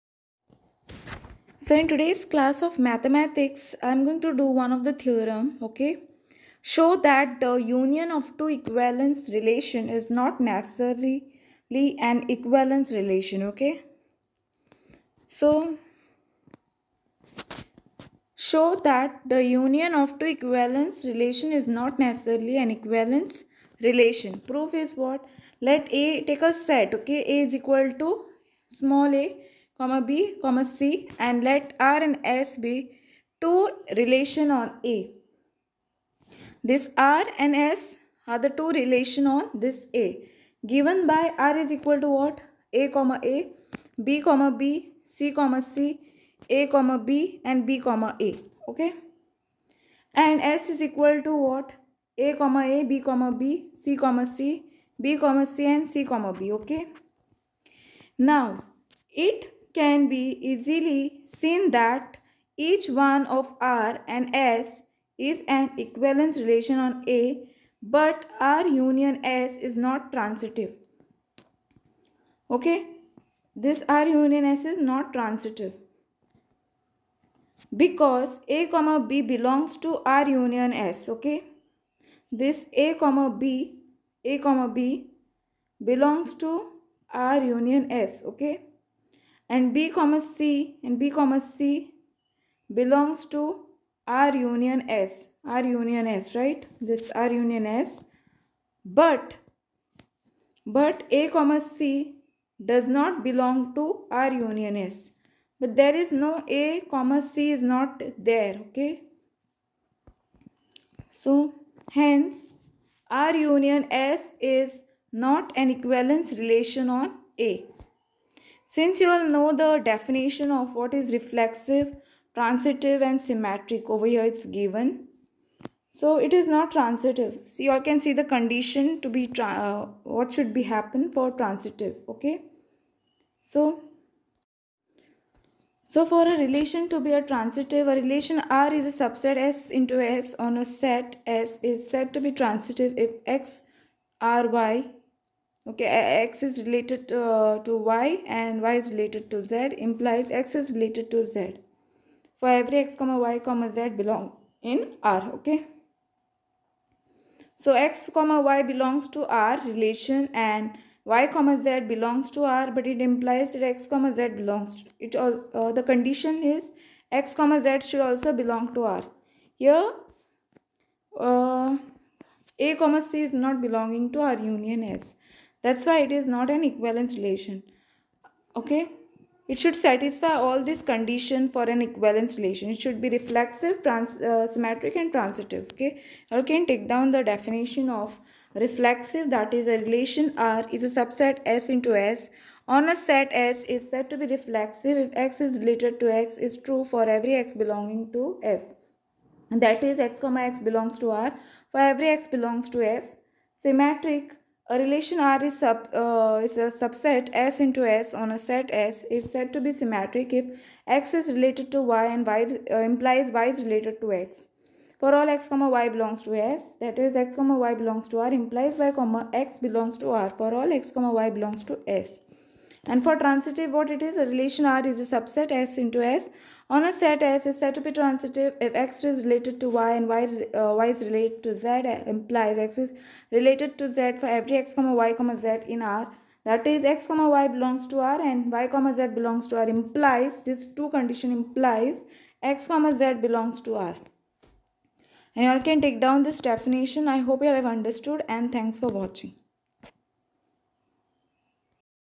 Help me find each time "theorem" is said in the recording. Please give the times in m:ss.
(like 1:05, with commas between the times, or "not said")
0:04.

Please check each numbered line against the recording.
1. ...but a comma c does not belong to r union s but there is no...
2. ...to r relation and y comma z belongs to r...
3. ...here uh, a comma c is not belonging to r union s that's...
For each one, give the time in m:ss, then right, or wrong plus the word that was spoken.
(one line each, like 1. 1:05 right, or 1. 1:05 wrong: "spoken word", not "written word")
1. 1:40 right
2. 2:39 right
3. 2:49 right.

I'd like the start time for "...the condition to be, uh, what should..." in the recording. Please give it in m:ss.
2:08.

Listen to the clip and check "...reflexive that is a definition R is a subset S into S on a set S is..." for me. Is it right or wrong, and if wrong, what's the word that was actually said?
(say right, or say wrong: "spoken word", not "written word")
wrong: "relation", not "definition".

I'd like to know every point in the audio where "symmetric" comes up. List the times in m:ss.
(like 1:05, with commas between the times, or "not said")
2:03, 3:04, 3:23, 3:29.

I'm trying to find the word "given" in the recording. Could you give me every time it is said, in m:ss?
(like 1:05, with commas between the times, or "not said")
0:40, 2:04.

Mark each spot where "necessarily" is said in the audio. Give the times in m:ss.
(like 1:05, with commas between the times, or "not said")
0:10, 0:21.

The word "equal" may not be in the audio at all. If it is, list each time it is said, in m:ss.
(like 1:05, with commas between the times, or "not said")
0:27, 0:41, 0:50.